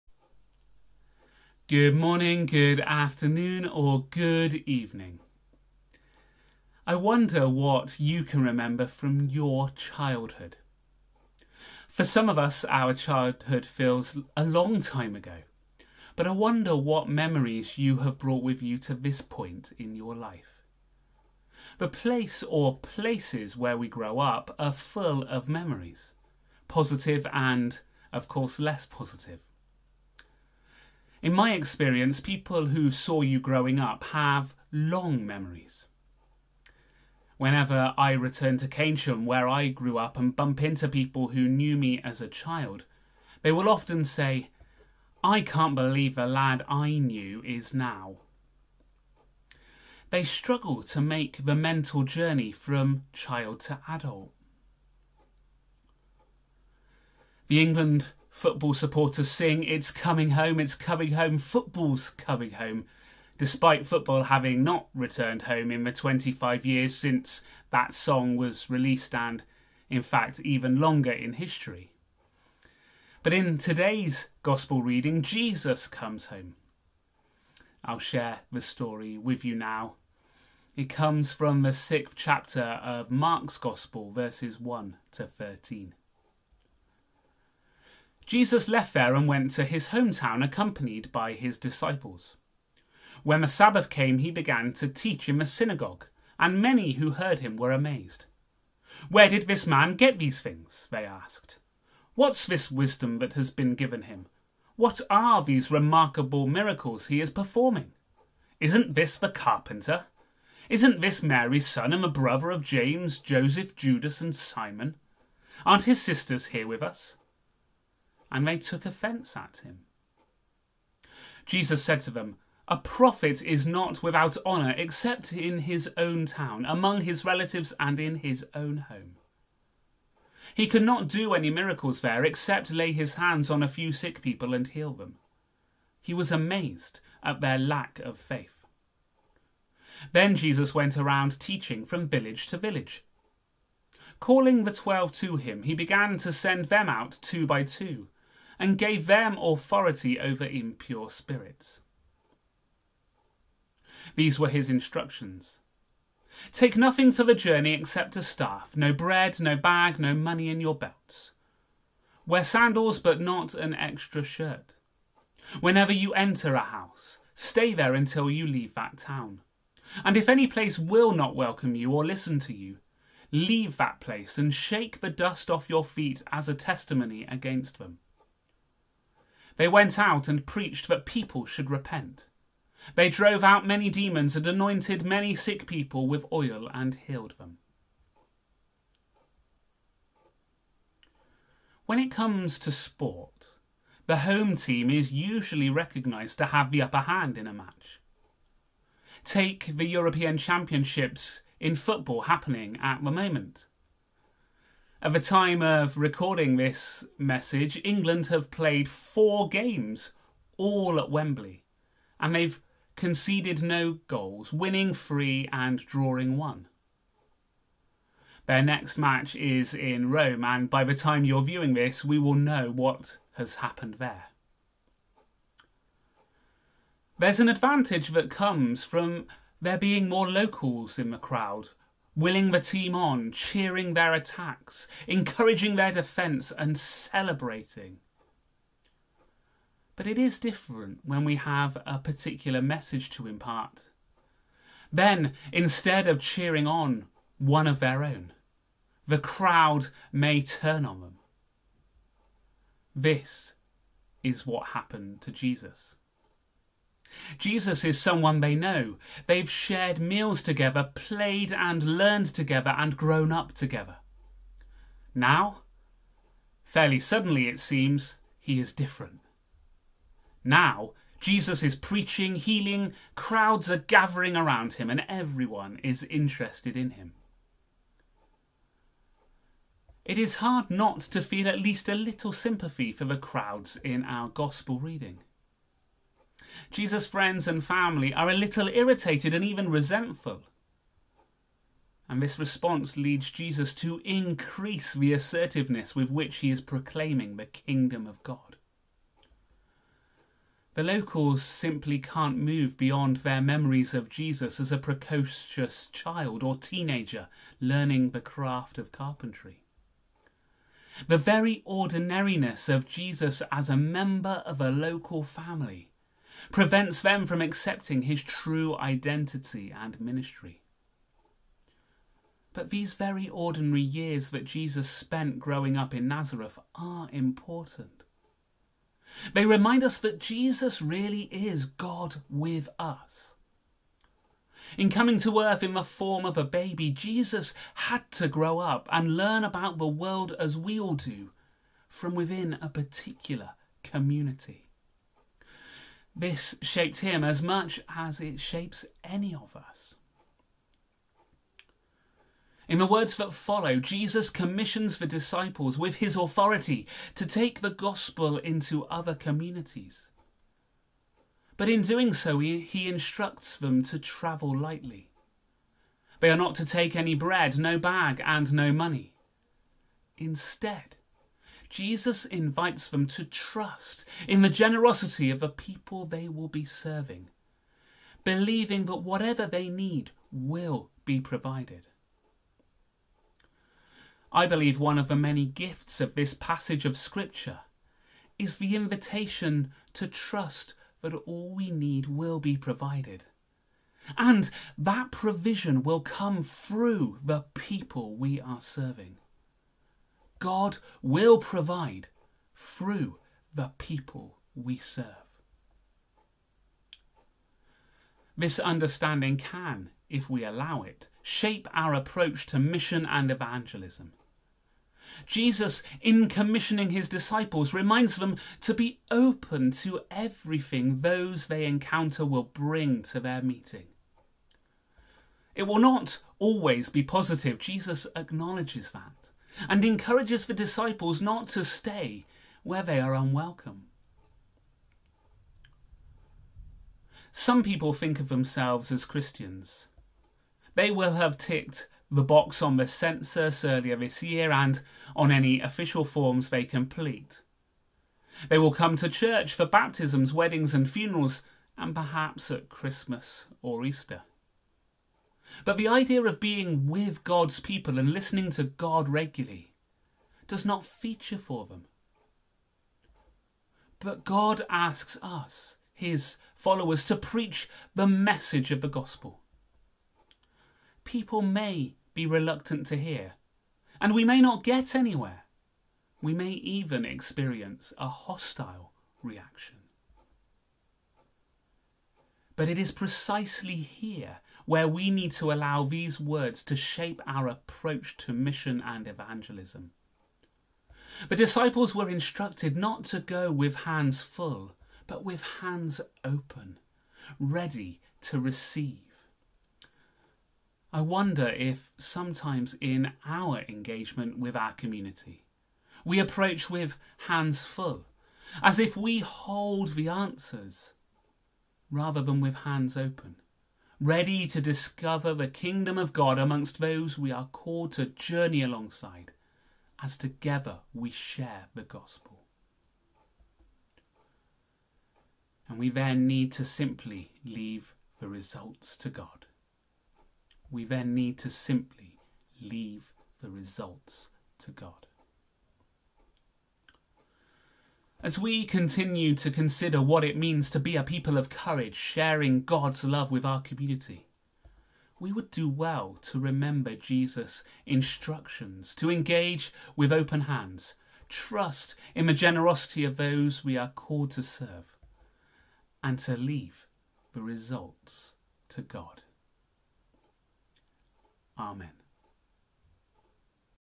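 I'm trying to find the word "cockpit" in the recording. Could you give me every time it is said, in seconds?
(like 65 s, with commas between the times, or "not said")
not said.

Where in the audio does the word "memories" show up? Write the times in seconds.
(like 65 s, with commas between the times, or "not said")
17 s, 25 s, 35 s, 303 s.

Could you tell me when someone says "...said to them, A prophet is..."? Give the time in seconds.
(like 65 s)
121 s.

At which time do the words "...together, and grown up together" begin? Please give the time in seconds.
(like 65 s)
262 s.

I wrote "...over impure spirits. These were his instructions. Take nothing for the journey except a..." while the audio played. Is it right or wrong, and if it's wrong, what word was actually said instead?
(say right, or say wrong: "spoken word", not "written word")
right.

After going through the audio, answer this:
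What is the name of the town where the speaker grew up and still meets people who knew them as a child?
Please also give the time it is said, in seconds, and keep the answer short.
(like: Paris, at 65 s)
Keynsham, at 38 s.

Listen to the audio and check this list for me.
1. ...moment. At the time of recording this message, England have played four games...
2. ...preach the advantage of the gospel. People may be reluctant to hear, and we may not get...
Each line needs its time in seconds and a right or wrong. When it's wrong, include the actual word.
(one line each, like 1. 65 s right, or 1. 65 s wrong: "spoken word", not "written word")
1. 203 s right
2. 467 s wrong: "message", not "advantage".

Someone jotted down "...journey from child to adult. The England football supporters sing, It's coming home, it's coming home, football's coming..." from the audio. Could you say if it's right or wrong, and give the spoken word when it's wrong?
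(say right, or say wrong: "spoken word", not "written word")
right.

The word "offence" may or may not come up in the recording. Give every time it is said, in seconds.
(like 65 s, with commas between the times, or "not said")
118 s.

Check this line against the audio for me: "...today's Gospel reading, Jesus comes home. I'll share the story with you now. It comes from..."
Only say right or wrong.
right.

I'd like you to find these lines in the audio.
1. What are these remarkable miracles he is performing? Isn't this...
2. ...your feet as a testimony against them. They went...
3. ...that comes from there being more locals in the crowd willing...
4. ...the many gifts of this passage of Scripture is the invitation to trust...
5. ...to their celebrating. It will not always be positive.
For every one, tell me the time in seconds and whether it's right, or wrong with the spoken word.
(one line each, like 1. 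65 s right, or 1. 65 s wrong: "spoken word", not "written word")
1. 104 s right
2. 175 s right
3. 228 s right
4. 385 s right
5. 423 s wrong: "meeting", not "celebrating".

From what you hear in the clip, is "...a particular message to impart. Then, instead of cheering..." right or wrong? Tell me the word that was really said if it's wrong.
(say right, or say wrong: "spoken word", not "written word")
right.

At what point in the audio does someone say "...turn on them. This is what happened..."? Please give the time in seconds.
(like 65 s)
250 s.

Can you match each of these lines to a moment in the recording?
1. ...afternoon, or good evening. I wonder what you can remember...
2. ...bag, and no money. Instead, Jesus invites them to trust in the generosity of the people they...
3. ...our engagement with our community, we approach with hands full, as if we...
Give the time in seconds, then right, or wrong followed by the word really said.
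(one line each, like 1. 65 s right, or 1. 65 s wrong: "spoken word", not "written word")
1. 2 s right
2. 367 s right
3. 503 s right.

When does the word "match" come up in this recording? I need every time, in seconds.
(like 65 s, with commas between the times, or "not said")
197 s, 218 s.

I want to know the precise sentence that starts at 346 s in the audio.
This shaped him as much as it shapes any of us.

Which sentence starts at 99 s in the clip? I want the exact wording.
Where did this man get these things?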